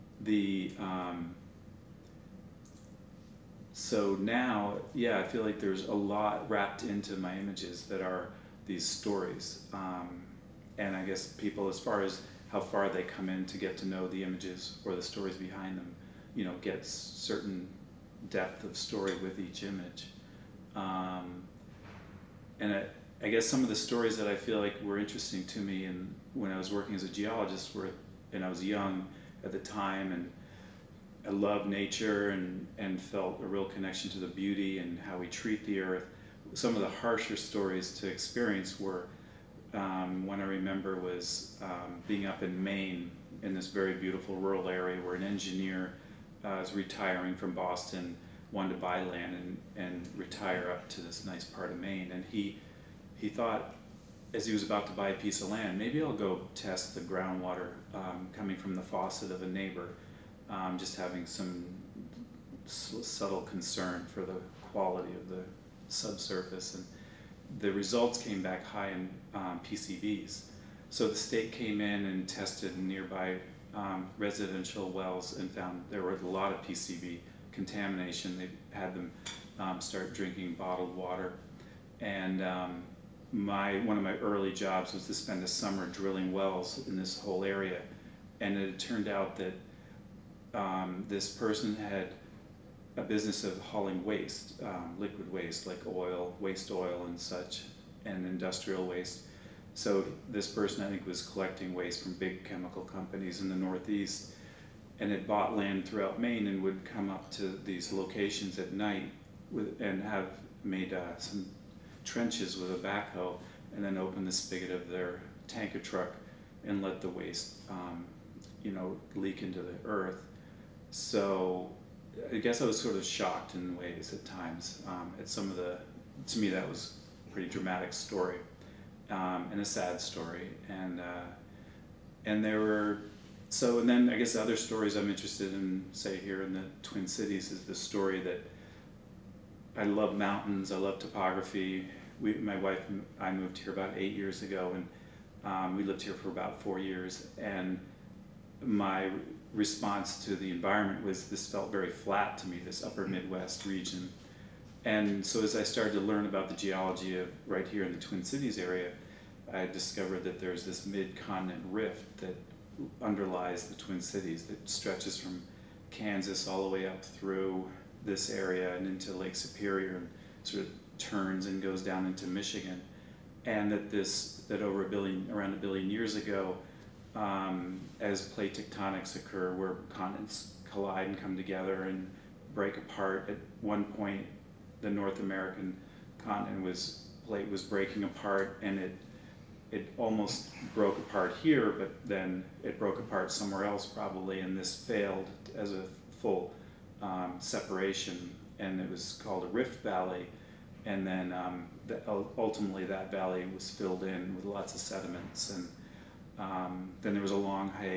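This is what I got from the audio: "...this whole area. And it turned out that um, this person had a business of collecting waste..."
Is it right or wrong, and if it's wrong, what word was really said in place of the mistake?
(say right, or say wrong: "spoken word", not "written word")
wrong: "hauling", not "collecting".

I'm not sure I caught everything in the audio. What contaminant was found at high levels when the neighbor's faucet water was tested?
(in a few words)
PCBs.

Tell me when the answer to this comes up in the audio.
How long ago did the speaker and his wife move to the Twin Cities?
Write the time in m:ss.
2:23.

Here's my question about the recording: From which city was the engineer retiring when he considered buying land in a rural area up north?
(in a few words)
Boston.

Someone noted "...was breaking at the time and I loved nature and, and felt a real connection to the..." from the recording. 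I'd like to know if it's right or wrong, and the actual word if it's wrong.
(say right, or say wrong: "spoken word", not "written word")
wrong: "young", not "breaking".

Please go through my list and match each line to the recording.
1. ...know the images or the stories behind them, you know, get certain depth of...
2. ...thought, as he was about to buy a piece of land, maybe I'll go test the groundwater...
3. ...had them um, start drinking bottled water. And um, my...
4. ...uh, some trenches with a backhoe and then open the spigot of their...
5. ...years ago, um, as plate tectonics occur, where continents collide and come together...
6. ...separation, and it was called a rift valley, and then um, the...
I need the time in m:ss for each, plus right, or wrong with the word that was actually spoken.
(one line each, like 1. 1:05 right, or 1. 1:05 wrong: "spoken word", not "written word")
1. 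0:13 right
2. 0:53 right
3. 1:18 right
4. 1:50 right
5. 2:55 right
6. 3:17 right.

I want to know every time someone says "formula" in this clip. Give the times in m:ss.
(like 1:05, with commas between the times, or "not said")
not said.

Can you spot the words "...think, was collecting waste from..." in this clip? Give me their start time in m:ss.
1:40.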